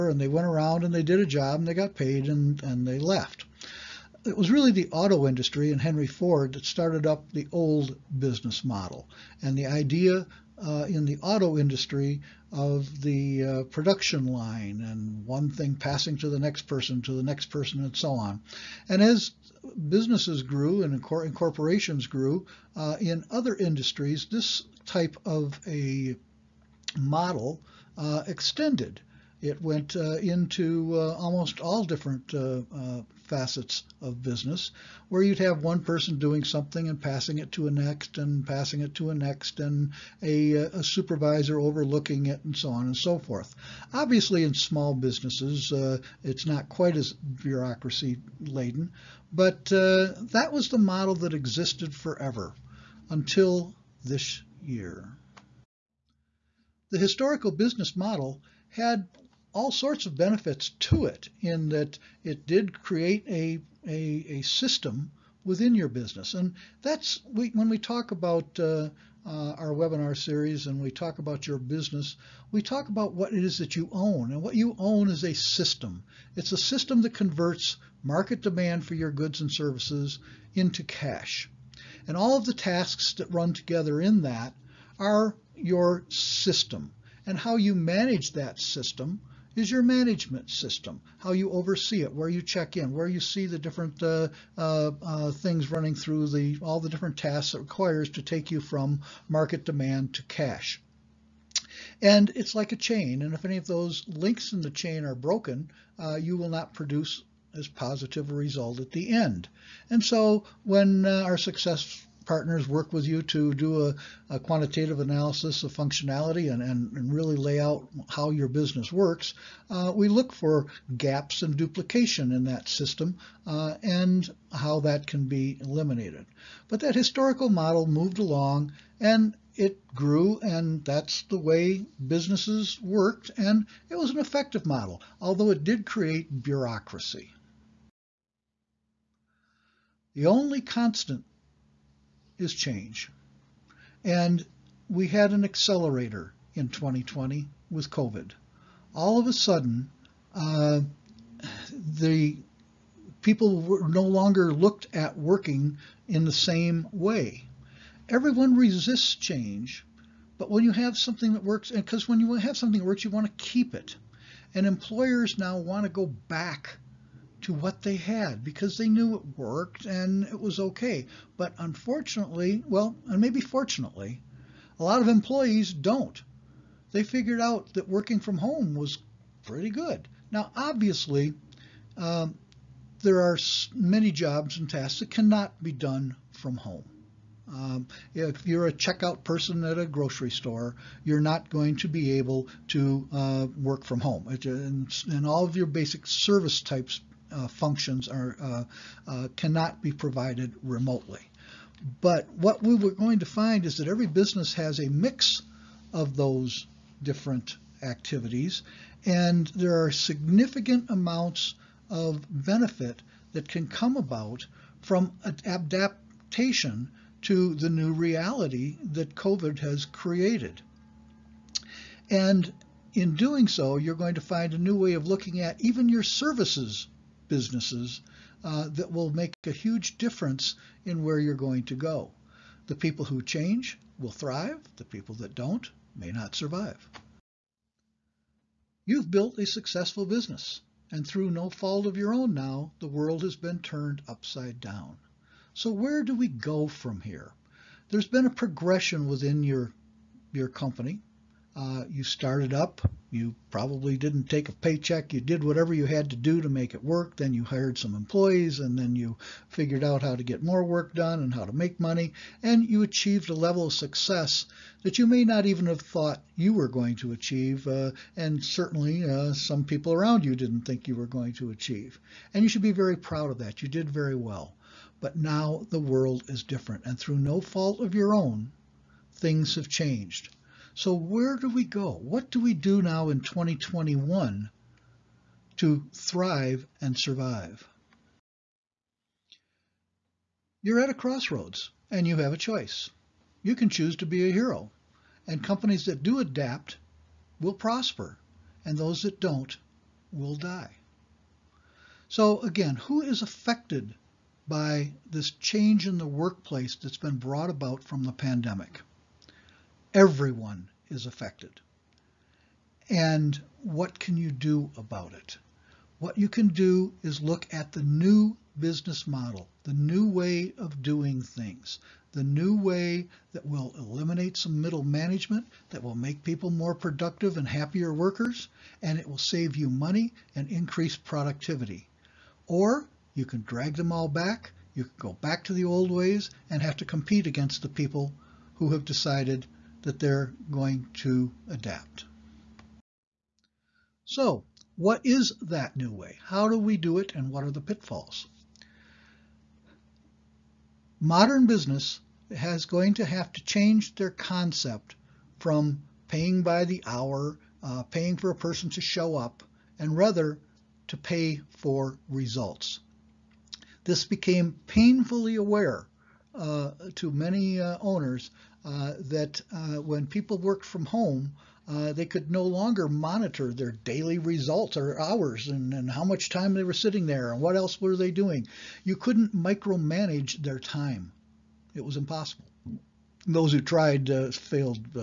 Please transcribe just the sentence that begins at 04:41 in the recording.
What do we do now in 2021 to thrive and survive?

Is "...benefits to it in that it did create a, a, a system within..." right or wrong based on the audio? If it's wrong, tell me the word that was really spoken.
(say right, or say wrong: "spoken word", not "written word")
right.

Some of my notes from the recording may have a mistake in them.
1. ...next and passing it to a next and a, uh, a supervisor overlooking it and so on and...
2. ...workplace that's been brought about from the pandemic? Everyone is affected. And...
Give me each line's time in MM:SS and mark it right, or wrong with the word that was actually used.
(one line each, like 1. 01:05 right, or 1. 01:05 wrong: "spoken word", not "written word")
1. 00:37 right
2. 05:06 right.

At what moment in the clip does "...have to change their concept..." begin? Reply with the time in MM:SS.
05:53.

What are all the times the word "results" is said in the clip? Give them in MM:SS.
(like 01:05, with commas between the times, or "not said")
01:48, 06:02, 06:14.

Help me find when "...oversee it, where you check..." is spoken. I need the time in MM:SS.
01:31.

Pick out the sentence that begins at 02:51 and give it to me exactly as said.
But unfortunately, well, and maybe fortunately, a lot of employees don't.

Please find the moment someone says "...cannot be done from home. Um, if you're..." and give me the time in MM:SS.
03:05.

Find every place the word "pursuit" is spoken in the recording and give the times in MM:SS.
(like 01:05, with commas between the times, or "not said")
not said.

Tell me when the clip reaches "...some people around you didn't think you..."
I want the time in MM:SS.
04:29.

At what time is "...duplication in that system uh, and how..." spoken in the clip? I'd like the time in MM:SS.
02:01.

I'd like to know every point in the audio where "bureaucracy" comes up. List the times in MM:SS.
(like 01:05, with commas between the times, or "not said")
00:47, 02:16.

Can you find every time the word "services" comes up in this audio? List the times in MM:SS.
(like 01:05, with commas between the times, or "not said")
01:19, 03:16, 03:46.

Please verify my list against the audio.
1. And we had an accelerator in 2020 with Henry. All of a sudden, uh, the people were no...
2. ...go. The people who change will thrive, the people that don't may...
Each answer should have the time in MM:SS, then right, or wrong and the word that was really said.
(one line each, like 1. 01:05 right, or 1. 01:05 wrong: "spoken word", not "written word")
1. 02:24 wrong: "COVID", not "Henry"
2. 03:51 right.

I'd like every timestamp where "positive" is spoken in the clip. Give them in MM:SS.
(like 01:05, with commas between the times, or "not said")
01:47.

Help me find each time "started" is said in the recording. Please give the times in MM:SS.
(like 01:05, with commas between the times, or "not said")
00:06, 04:12.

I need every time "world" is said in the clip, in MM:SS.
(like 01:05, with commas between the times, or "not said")
04:02, 04:35.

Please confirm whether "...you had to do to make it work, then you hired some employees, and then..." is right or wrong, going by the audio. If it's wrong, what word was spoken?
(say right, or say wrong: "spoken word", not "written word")
right.